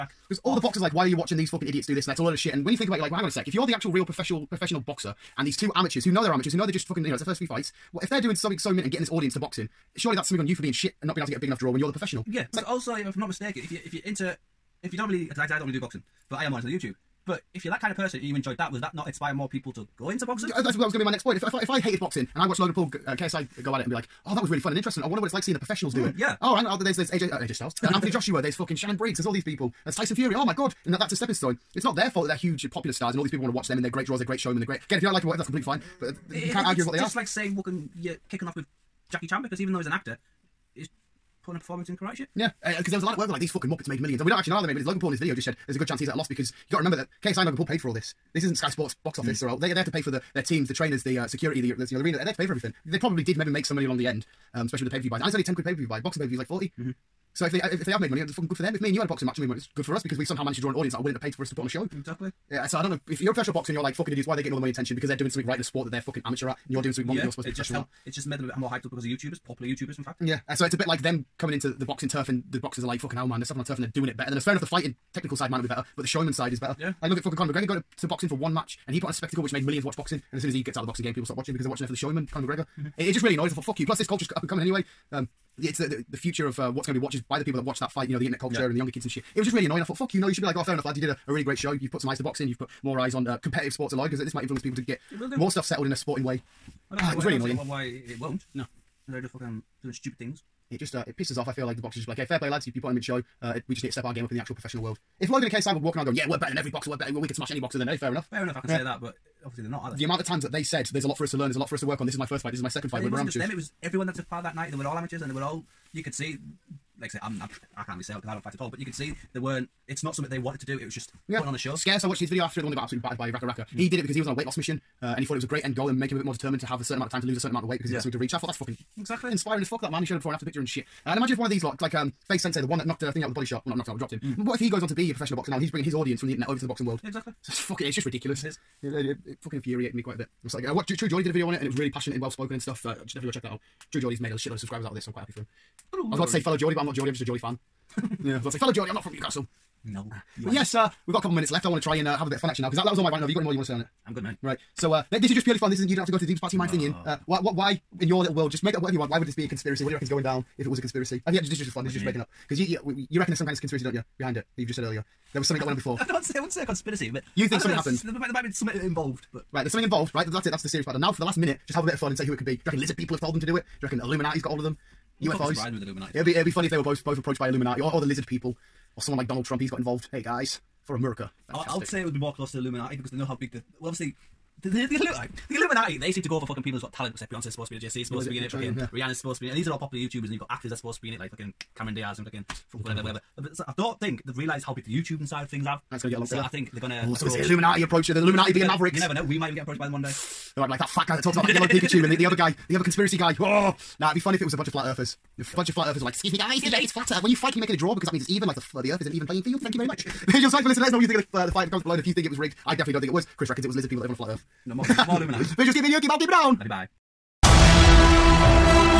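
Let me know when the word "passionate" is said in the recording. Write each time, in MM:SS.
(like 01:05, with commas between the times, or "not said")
02:21.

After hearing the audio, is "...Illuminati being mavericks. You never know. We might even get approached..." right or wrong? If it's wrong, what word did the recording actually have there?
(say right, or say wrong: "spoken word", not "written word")
right.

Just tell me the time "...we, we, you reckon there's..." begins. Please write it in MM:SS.
02:42.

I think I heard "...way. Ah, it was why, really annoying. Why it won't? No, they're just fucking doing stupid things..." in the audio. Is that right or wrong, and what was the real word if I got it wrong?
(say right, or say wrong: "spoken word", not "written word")
right.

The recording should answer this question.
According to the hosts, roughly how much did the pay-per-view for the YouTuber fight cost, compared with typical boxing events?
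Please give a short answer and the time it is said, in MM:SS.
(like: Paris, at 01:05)
10 quid, at 00:55.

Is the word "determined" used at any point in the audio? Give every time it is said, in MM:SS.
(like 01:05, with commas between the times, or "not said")
02:06.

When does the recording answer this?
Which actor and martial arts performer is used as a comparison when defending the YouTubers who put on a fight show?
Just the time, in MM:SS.
00:39.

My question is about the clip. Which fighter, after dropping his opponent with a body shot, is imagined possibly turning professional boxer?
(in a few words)
FaZe Sensei.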